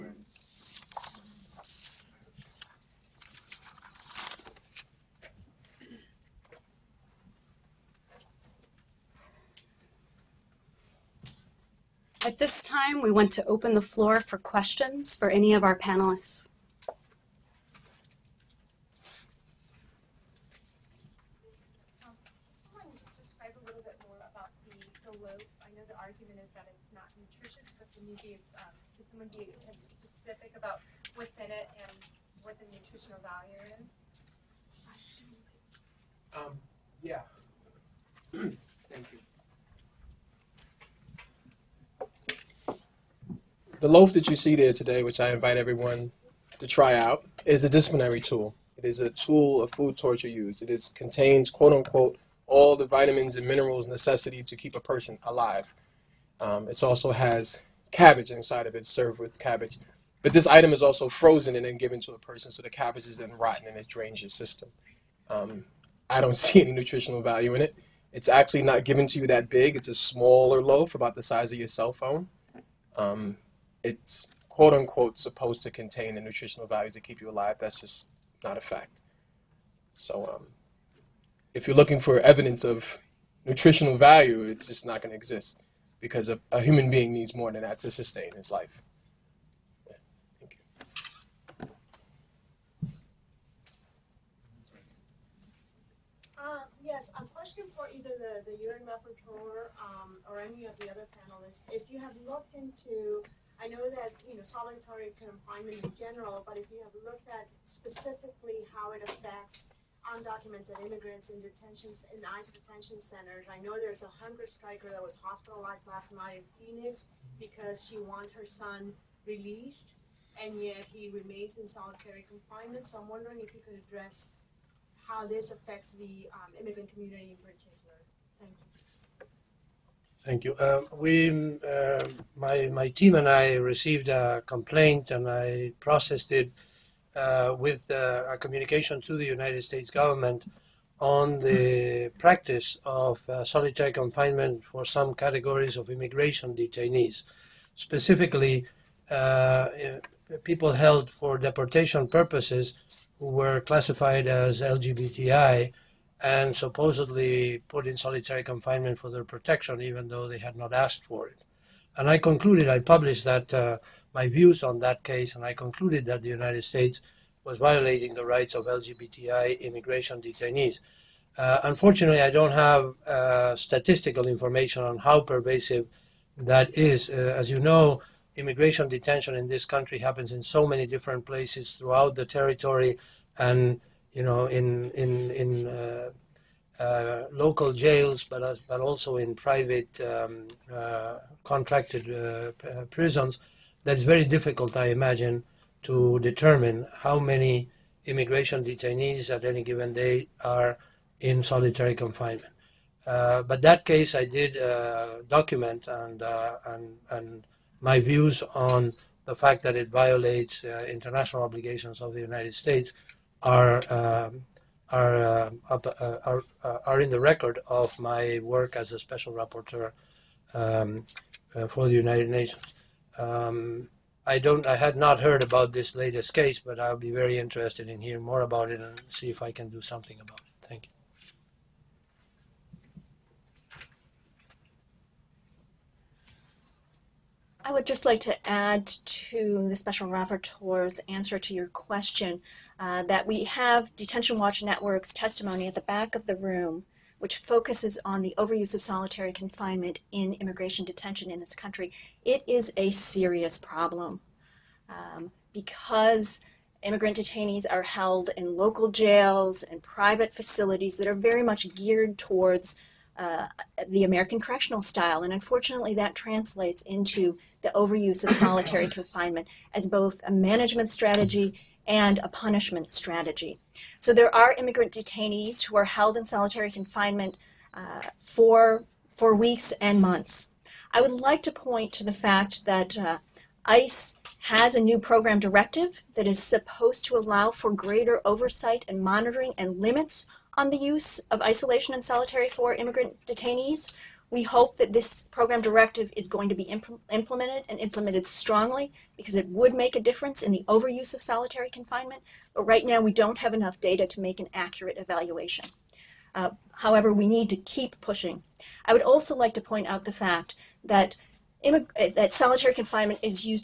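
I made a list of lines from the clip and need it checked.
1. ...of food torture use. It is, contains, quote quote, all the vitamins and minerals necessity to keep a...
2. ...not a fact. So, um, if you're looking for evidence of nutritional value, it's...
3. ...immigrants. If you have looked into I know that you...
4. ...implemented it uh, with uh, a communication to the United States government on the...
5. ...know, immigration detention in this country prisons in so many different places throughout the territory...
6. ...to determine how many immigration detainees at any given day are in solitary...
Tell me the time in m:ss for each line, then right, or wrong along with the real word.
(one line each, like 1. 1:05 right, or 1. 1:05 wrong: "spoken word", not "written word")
1. 0:49 wrong: "unquote", not "quote"
2. 1:18 right
3. 1:41 wrong: "panelists", not "immigrants"
4. 2:15 wrong: "processed", not "implemented"
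5. 2:57 wrong: "happens", not "prisons"
6. 3:15 right.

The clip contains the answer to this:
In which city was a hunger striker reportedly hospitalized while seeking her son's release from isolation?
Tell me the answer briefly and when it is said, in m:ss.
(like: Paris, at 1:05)
Phoenix, at 1:56.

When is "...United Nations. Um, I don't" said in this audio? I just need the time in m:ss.
3:41.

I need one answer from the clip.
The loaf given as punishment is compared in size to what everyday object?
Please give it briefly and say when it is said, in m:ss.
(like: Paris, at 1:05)
cell phone, at 1:11.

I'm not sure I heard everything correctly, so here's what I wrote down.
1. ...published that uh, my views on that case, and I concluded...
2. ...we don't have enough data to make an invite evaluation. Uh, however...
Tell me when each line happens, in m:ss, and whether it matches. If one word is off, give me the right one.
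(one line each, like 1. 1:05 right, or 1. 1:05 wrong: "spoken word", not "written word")
1. 2:42 right
2. 5:02 wrong: "accurate", not "invite".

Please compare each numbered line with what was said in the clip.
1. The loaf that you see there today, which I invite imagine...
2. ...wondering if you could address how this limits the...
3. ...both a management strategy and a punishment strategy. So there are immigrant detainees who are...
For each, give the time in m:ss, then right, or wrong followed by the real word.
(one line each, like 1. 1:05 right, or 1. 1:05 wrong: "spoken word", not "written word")
1. 0:43 wrong: "everyone", not "imagine"
2. 2:03 wrong: "affects", not "limits"
3. 4:29 right.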